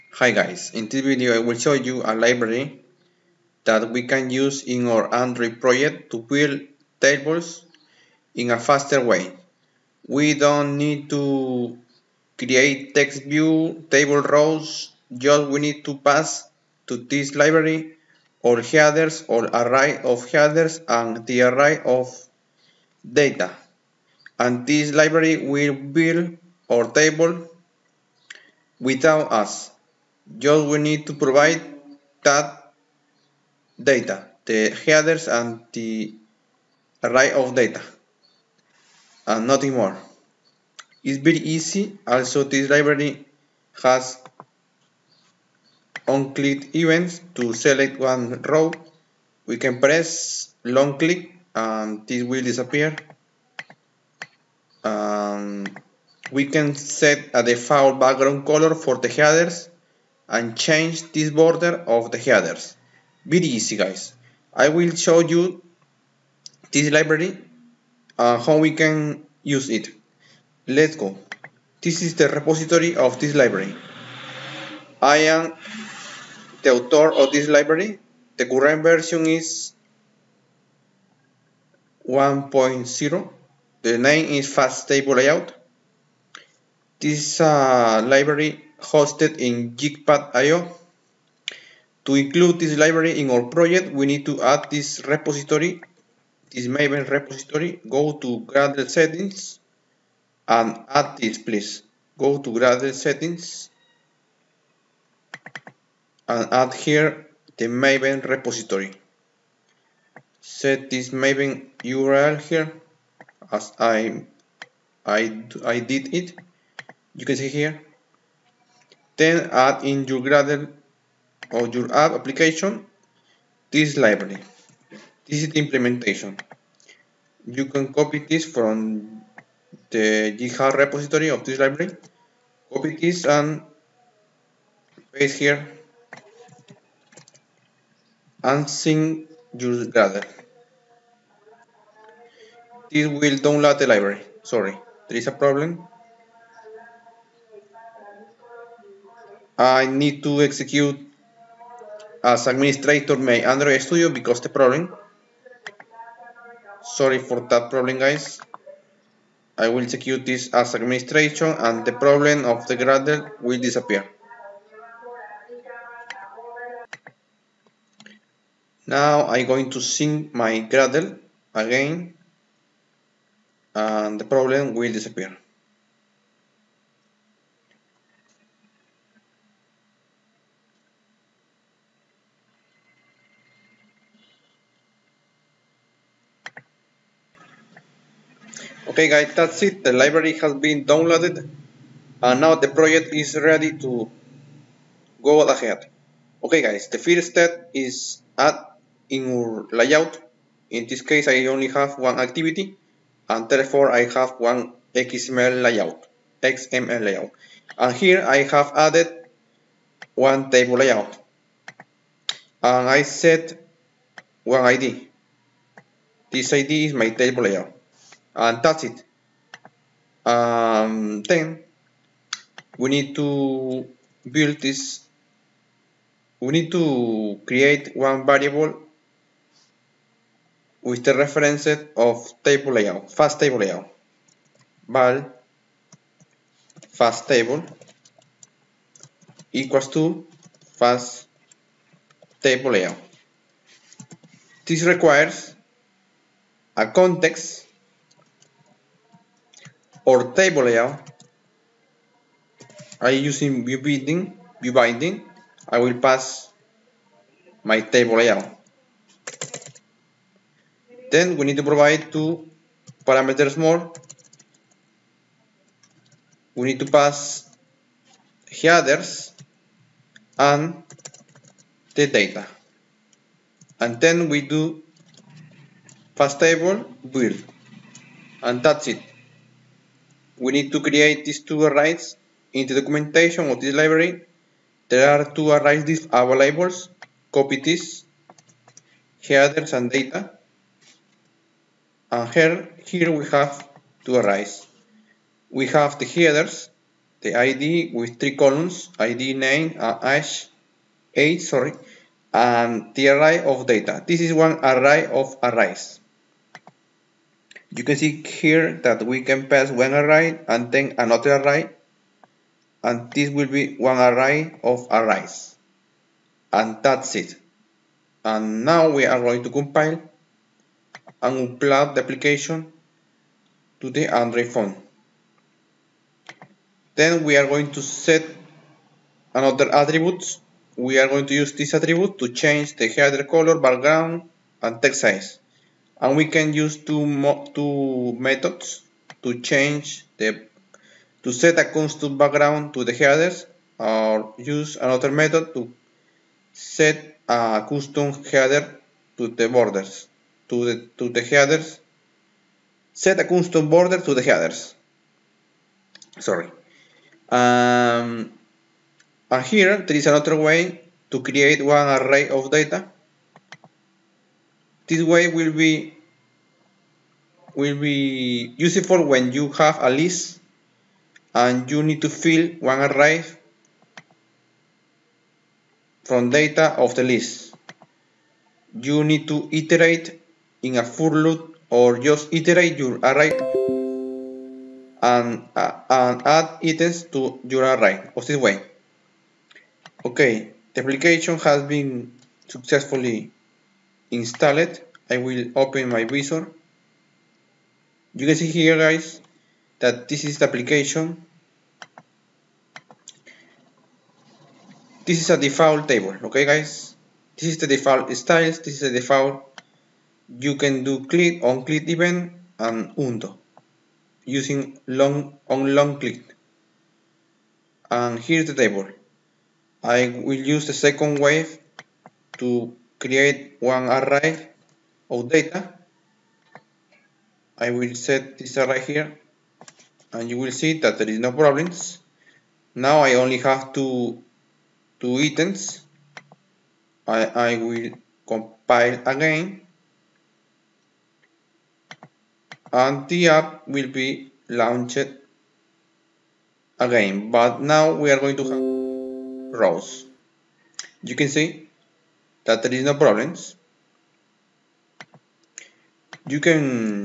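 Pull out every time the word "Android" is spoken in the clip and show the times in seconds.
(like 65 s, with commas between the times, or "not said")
5 s, 153 s, 324 s.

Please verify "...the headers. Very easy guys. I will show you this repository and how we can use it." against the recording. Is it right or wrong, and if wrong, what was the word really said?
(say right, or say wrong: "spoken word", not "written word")
wrong: "library", not "repository".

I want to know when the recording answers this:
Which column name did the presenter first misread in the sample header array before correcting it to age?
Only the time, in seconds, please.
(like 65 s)
300 s.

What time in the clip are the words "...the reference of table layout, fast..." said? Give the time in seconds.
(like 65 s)
231 s.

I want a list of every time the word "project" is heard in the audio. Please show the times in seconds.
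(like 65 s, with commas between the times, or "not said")
5 s, 93 s, 192 s.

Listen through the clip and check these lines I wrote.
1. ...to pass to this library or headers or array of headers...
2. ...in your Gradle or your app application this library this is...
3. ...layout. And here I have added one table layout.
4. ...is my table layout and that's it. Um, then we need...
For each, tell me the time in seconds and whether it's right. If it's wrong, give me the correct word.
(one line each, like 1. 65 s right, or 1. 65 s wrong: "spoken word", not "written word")
1. 15 s right
2. 119 s right
3. 207 s right
4. 216 s right.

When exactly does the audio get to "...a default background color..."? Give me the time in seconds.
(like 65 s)
57 s.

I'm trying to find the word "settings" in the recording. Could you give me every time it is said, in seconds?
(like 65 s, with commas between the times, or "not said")
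98 s, 102 s.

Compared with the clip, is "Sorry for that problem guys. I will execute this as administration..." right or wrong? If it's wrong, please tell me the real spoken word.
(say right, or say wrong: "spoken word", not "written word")
right.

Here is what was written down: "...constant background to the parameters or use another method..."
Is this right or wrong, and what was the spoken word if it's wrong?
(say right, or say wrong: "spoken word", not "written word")
wrong: "headers", not "parameters".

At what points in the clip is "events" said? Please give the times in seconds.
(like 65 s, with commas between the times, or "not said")
46 s, 411 s.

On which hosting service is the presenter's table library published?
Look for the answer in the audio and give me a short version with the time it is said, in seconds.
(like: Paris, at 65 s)
JitPack.io, at 89 s.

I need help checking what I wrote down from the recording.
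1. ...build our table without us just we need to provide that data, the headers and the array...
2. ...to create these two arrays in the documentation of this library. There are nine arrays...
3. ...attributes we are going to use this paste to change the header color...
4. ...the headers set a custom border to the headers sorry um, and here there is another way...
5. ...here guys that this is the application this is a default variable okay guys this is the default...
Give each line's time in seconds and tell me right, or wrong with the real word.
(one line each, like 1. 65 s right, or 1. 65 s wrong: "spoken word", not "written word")
1. 25 s right
2. 280 s wrong: "two", not "nine"
3. 329 s wrong: "attribute", not "paste"
4. 351 s right
5. 398 s wrong: "table", not "variable".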